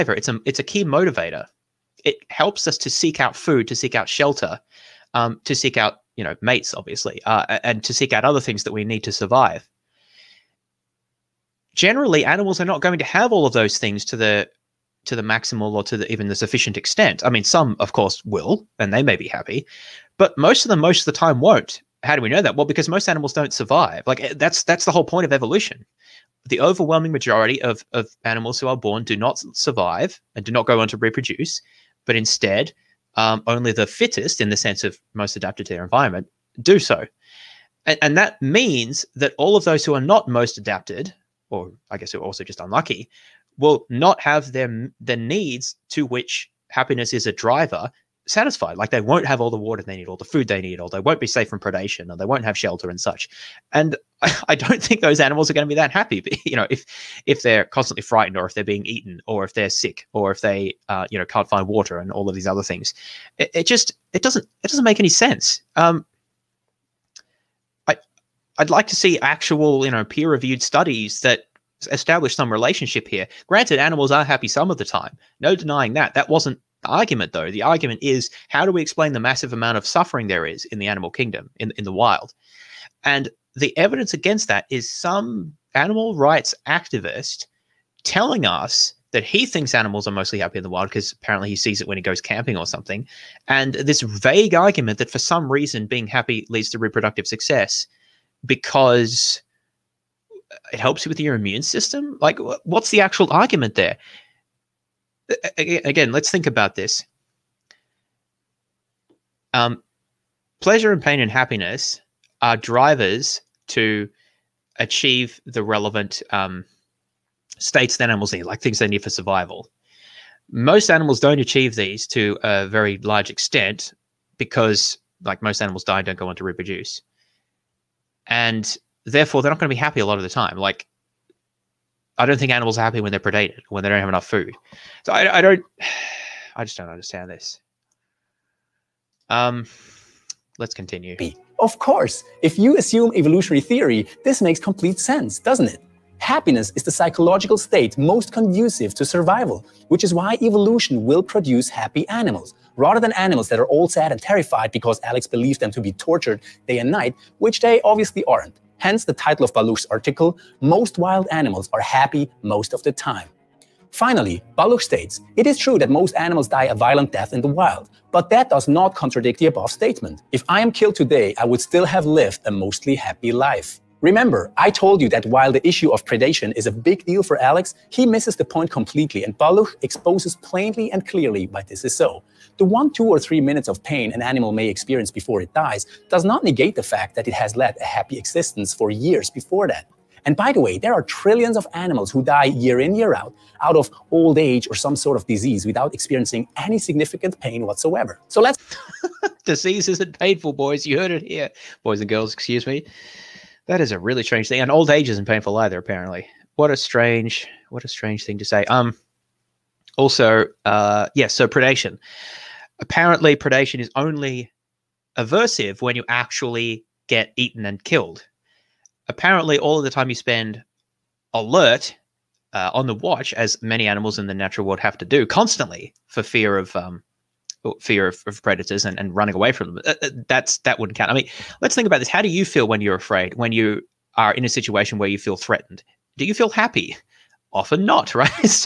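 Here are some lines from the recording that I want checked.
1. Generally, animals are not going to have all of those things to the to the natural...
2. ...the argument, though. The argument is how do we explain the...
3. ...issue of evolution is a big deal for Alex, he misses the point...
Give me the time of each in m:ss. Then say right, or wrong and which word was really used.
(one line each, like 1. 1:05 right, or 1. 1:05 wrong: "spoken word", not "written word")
1. 0:11 wrong: "maximal", not "natural"
2. 1:16 right
3. 2:55 wrong: "predation", not "evolution".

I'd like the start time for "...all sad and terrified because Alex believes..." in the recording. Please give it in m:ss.
2:33.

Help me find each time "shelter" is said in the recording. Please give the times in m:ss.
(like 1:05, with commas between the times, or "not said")
0:04, 0:52.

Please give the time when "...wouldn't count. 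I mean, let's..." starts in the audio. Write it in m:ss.
3:50.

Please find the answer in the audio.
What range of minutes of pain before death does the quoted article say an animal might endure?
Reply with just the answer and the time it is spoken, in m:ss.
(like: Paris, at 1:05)
1, 2, or 3 minutes, at 3:02.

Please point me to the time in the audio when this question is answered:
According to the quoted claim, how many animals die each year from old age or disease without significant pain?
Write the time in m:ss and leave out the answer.
3:11.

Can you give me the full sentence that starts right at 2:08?
And therefore they're not going to be happy a lot of the time.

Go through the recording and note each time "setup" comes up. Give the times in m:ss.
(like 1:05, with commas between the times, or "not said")
not said.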